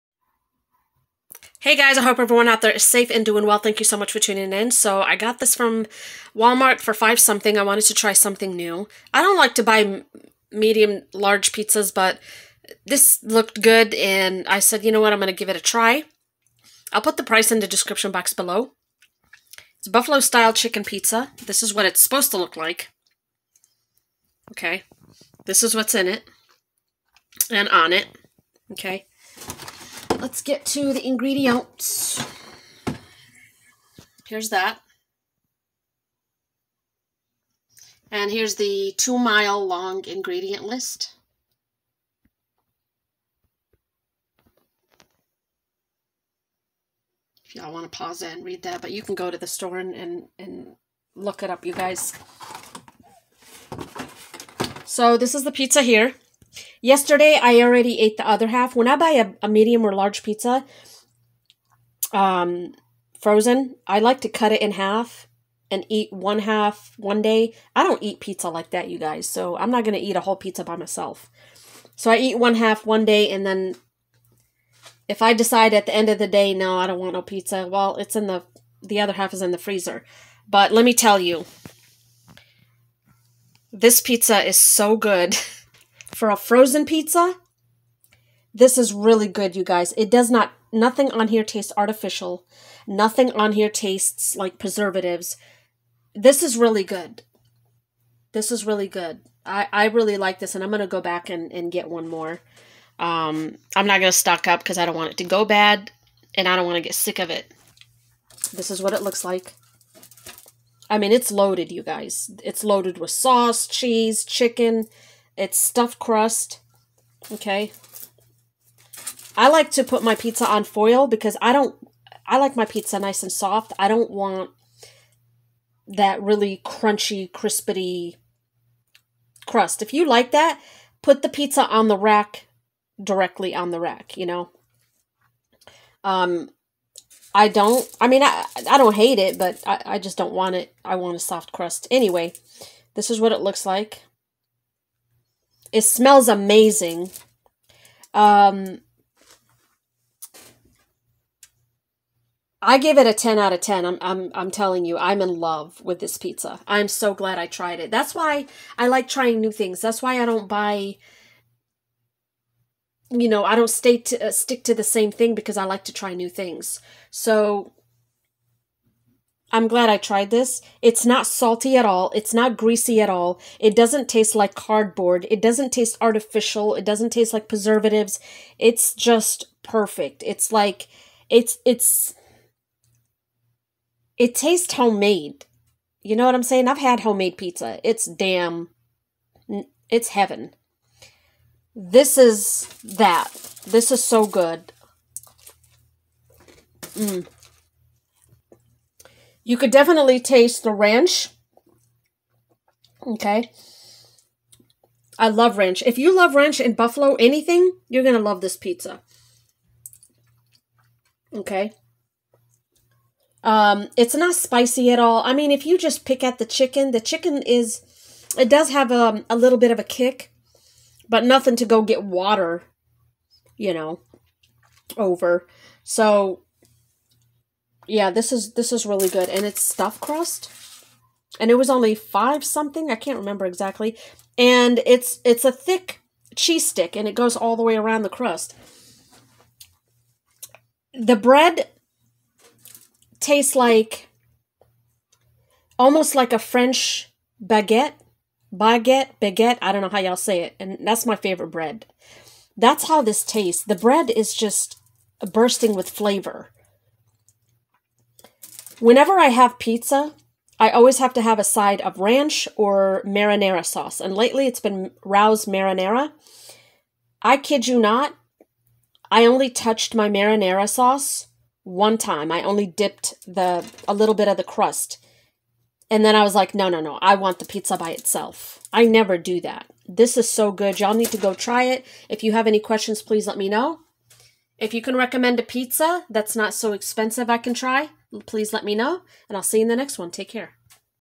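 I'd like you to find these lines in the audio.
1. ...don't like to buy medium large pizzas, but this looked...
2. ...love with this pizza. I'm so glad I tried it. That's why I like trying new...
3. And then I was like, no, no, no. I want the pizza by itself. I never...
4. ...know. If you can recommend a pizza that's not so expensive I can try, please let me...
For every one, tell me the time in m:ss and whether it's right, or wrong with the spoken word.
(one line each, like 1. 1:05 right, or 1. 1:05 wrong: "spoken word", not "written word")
1. 0:09 right
2. 2:35 right
3. 4:35 right
4. 4:43 right.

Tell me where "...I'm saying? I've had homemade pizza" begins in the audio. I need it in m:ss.
3:06.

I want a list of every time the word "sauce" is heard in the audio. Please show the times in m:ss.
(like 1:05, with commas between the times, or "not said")
1:53, 4:23, 4:30.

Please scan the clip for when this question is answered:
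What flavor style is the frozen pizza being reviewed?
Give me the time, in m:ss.
0:19.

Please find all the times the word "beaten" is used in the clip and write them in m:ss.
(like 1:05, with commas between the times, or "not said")
not said.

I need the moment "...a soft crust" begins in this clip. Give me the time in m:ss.
2:21.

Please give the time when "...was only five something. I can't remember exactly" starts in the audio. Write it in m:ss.
3:51.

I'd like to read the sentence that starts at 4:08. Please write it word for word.
Baguette, baguette, I don't know how y'all say it.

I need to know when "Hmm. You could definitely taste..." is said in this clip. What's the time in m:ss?
3:16.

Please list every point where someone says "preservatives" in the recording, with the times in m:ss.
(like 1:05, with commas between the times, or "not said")
1:34, 2:57.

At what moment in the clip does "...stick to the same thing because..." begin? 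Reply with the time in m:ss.
2:44.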